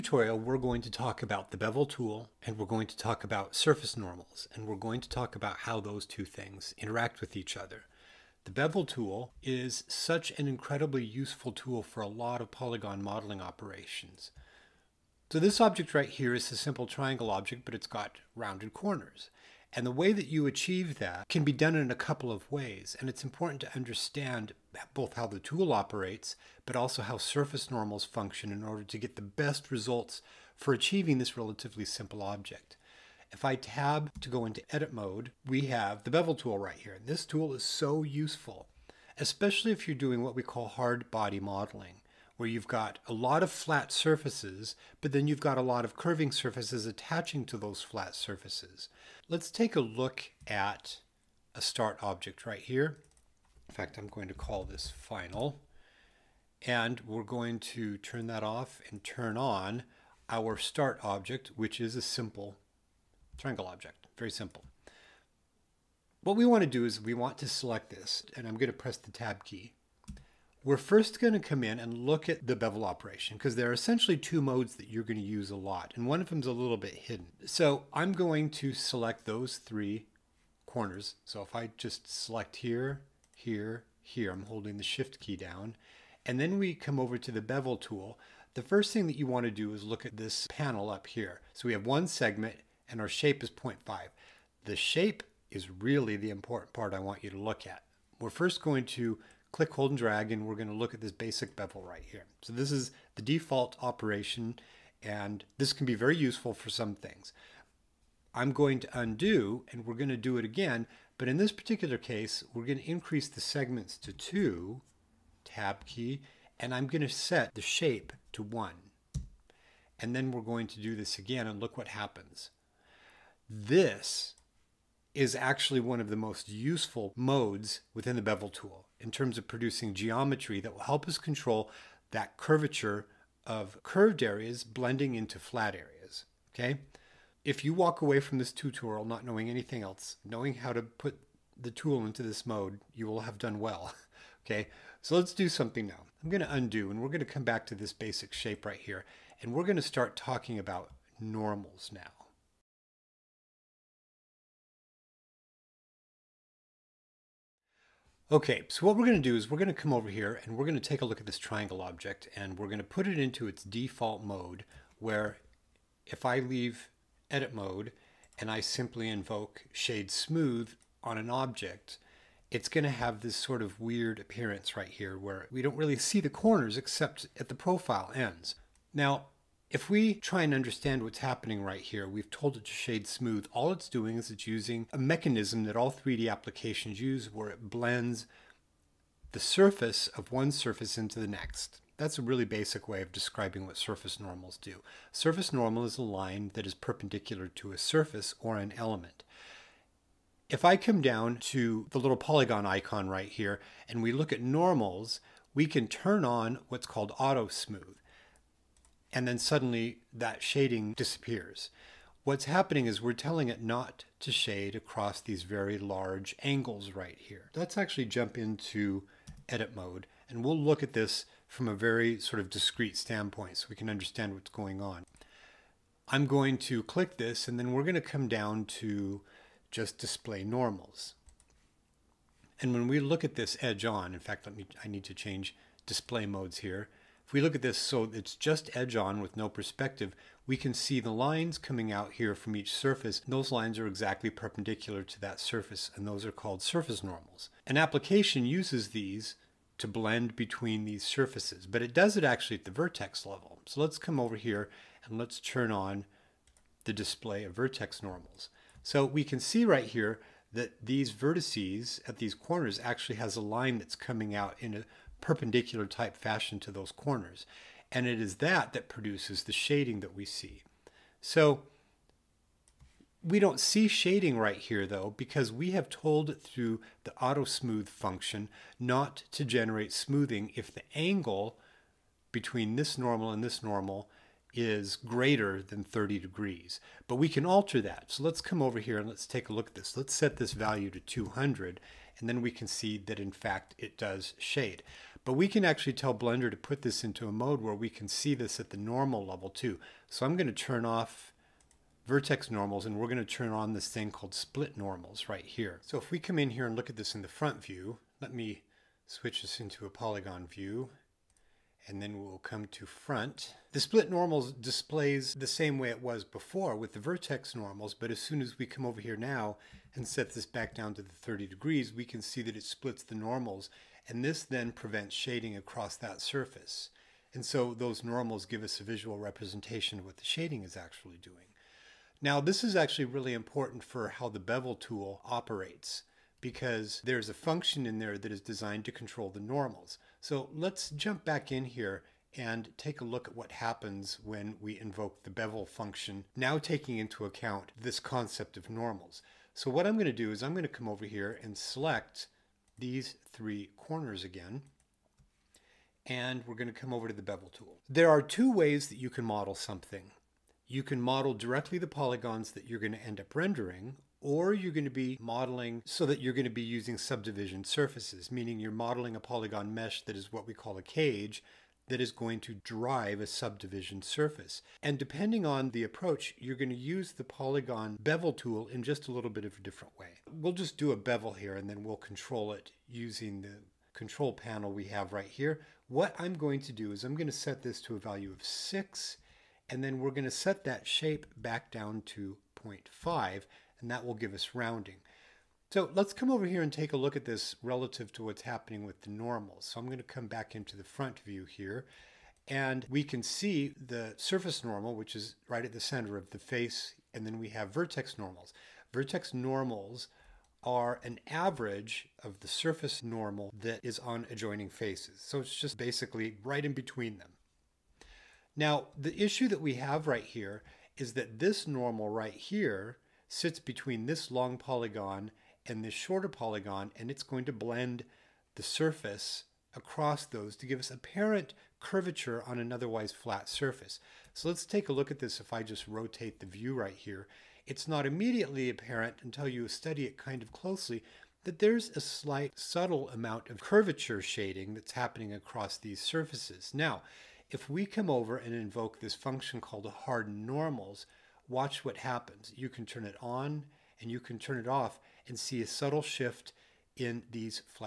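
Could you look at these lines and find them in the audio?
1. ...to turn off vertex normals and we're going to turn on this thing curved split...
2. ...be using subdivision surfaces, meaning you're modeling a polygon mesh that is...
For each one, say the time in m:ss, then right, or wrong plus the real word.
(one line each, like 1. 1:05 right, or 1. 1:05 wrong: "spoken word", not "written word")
1. 5:00 wrong: "called", not "curved"
2. 6:06 right.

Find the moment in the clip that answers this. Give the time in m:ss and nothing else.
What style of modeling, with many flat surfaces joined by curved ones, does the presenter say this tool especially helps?
0:40.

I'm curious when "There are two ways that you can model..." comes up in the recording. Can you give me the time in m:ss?
5:57.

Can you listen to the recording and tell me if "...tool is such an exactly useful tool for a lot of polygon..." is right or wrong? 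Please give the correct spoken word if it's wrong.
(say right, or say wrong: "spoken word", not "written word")
wrong: "incredibly", not "exactly".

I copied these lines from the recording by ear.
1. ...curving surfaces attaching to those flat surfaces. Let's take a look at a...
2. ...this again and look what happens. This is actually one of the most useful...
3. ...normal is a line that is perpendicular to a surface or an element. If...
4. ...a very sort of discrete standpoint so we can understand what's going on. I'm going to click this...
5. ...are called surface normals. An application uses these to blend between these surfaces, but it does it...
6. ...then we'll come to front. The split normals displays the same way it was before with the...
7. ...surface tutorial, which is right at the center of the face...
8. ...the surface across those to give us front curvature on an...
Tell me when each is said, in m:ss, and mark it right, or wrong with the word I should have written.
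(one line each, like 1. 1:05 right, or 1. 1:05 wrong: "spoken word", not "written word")
1. 0:45 right
2. 2:00 right
3. 3:15 right
4. 3:41 right
5. 4:06 right
6. 5:12 right
7. 6:44 wrong: "normal", not "tutorial"
8. 7:08 wrong: "apparent", not "front".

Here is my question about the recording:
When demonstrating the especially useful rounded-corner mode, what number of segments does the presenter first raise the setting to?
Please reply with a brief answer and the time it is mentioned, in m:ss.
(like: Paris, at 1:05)
2, at 1:52.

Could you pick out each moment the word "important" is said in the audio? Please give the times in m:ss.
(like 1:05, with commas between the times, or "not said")
0:23, 1:36, 5:33.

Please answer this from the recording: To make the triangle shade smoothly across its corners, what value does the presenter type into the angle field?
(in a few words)
200.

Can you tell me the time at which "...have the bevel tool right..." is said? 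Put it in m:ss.
0:35.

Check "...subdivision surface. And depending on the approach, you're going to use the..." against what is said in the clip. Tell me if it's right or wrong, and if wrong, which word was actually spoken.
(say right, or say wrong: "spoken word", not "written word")
right.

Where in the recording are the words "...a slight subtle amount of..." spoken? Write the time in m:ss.
7:21.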